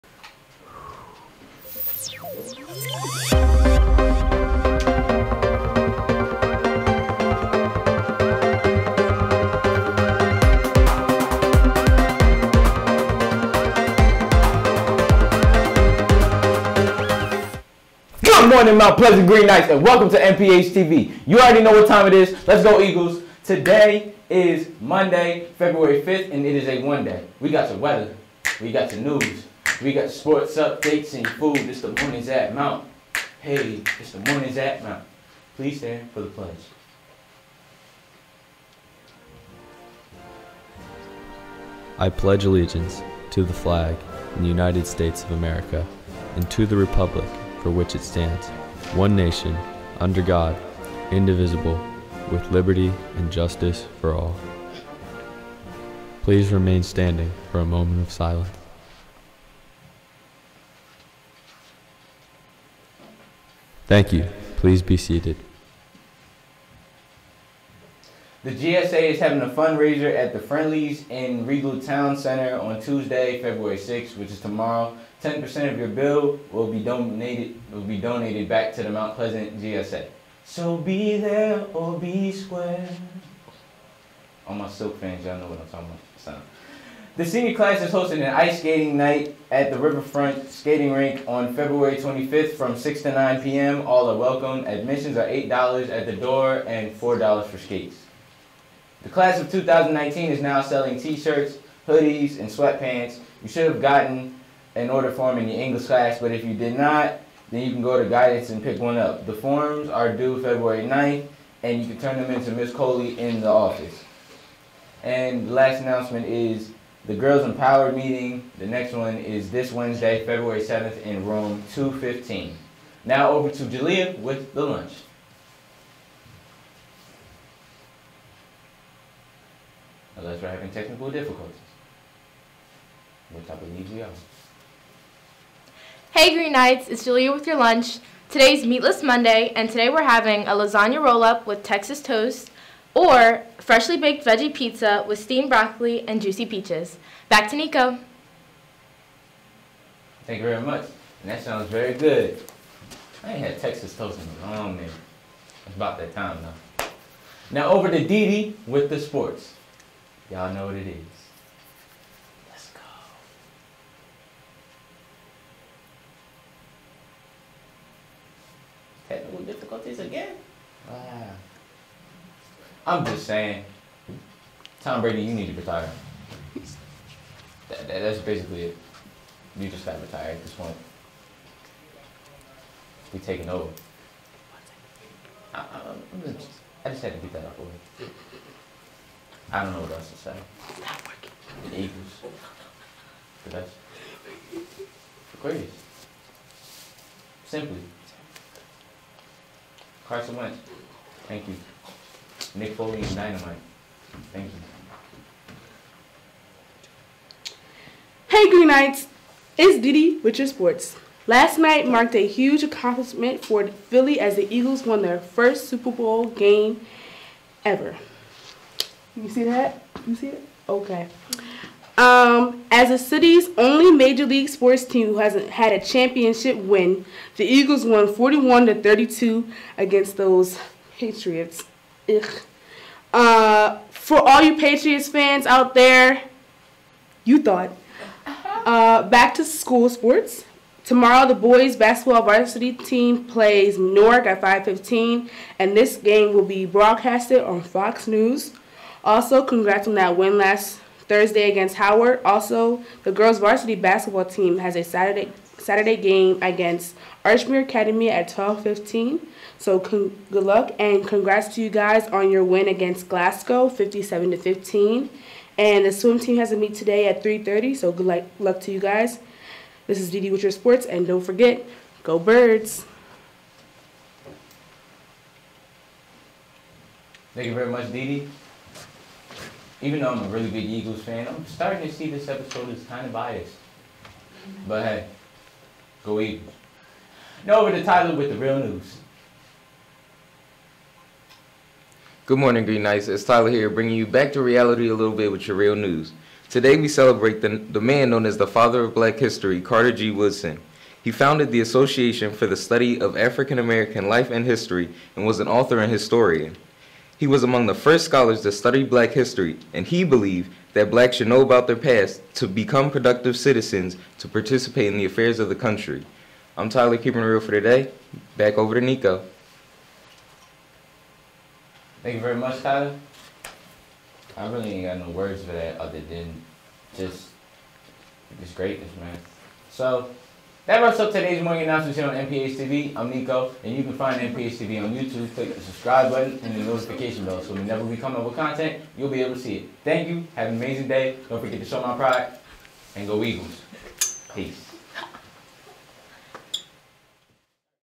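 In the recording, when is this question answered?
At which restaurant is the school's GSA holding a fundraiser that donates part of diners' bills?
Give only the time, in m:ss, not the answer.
1:10.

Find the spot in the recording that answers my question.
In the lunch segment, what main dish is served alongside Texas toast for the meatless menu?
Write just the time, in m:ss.
2:20.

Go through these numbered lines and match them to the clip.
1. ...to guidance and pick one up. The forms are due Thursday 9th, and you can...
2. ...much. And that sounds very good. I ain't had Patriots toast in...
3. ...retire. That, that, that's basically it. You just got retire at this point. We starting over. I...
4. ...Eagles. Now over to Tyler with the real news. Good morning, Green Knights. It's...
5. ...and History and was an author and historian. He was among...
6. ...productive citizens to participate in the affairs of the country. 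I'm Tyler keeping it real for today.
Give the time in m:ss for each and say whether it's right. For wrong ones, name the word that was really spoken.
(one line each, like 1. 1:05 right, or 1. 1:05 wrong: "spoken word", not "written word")
1. 1:48 wrong: "February", not "Thursday"
2. 2:30 wrong: "Texas", not "Patriots"
3. 2:55 wrong: "taking", not "starting"
4. 4:46 right
5. 5:04 right
6. 5:12 right.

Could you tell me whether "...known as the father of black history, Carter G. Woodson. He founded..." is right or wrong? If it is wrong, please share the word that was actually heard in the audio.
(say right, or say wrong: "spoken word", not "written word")
right.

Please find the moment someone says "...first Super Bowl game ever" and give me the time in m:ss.
3:35.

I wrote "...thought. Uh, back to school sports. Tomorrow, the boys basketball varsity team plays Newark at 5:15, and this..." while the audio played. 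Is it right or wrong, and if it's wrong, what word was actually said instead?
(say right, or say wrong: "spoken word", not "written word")
right.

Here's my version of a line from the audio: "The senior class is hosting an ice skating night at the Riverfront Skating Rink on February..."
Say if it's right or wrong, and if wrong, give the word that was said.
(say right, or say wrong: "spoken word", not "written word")
right.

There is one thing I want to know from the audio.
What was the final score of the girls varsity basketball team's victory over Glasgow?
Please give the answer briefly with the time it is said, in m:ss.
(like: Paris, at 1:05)
57 to 15, at 4:23.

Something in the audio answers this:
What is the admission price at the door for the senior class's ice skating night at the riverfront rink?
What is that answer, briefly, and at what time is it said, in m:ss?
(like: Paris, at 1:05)
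$8, at 1:35.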